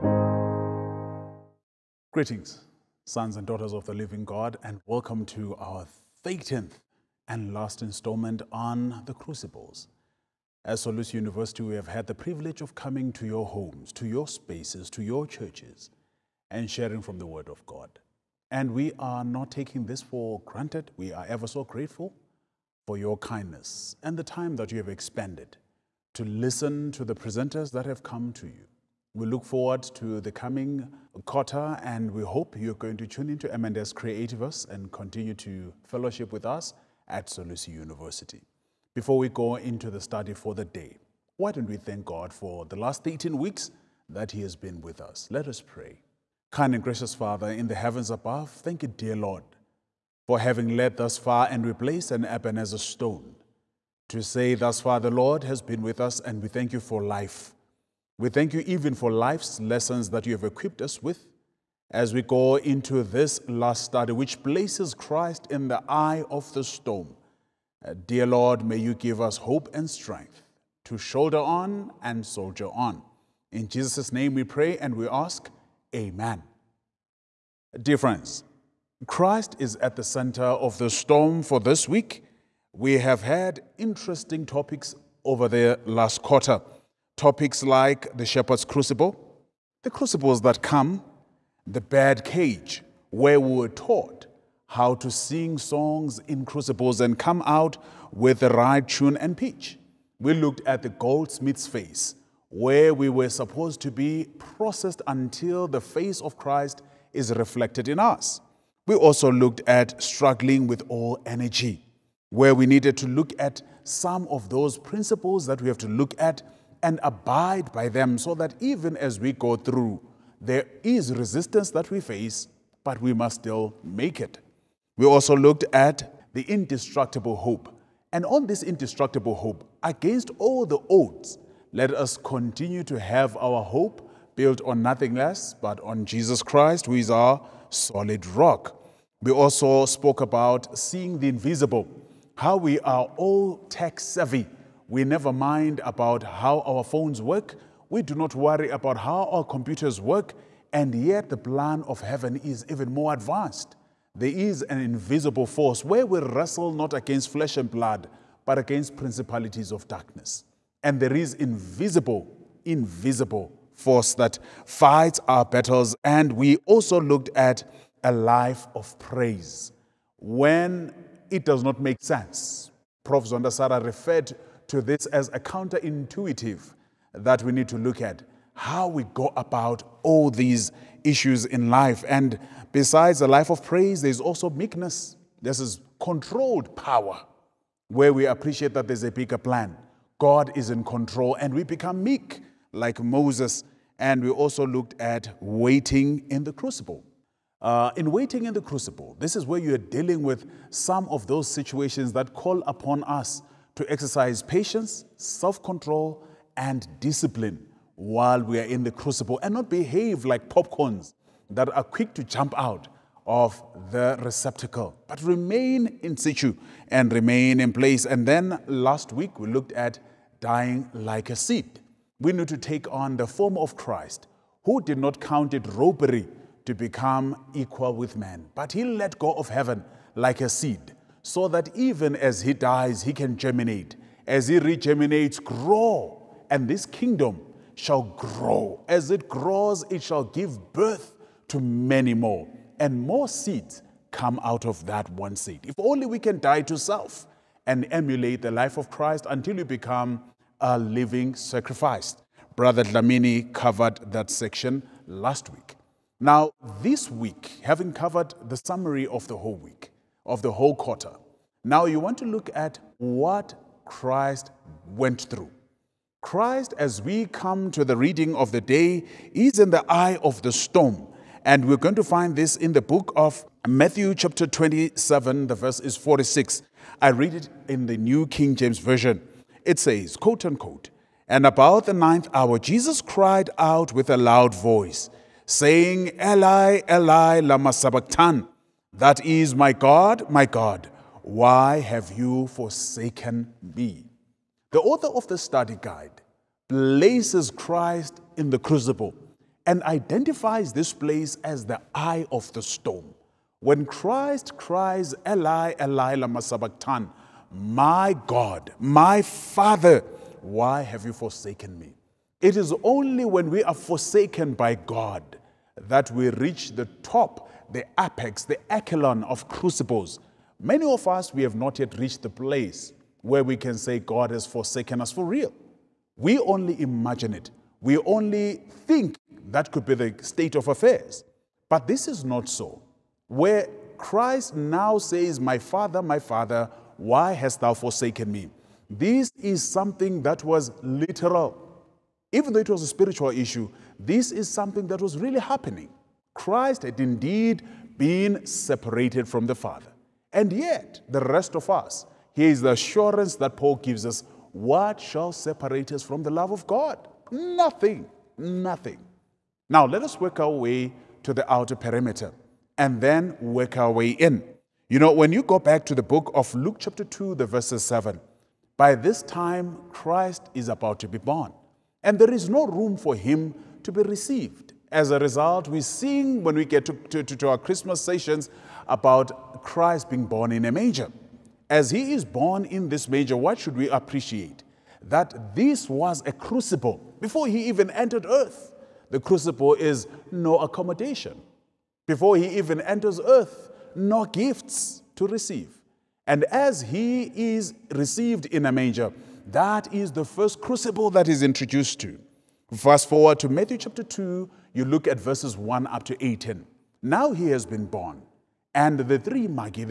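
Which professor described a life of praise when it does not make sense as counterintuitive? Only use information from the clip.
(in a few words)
Prof. Zondasara.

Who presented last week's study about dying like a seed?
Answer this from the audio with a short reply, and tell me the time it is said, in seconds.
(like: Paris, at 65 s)
Brother Dlamini, at 252 s.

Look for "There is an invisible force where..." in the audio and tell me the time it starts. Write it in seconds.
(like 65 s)
154 s.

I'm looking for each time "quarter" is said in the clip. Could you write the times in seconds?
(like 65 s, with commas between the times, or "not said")
31 s, 86 s, 260 s.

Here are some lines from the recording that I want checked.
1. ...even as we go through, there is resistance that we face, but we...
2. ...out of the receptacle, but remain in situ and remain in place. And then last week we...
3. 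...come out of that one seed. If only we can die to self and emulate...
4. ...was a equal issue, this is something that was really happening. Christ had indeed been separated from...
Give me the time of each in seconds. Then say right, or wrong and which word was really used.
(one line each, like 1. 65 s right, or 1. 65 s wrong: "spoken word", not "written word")
1. 118 s right
2. 212 s right
3. 244 s right
4. 342 s wrong: "spiritual", not "equal".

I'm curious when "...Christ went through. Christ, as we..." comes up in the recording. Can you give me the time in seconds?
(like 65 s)
263 s.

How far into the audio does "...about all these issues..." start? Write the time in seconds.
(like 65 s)
179 s.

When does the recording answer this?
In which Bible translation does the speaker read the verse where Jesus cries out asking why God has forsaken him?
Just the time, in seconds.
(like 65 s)
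277 s.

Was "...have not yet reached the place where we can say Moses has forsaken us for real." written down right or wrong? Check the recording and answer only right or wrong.
wrong.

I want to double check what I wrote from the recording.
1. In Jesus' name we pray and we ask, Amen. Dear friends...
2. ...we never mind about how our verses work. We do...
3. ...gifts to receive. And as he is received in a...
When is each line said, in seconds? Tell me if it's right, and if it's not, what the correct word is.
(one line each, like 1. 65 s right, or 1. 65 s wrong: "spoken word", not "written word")
1. 73 s right
2. 144 s wrong: "phones", not "verses"
3. 394 s right.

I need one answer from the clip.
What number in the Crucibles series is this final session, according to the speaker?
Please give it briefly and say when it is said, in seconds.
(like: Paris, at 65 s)
13th, at 6 s.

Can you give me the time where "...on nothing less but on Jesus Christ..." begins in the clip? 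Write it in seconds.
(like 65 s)
134 s.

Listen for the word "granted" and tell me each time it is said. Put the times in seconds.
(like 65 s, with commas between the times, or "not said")
20 s.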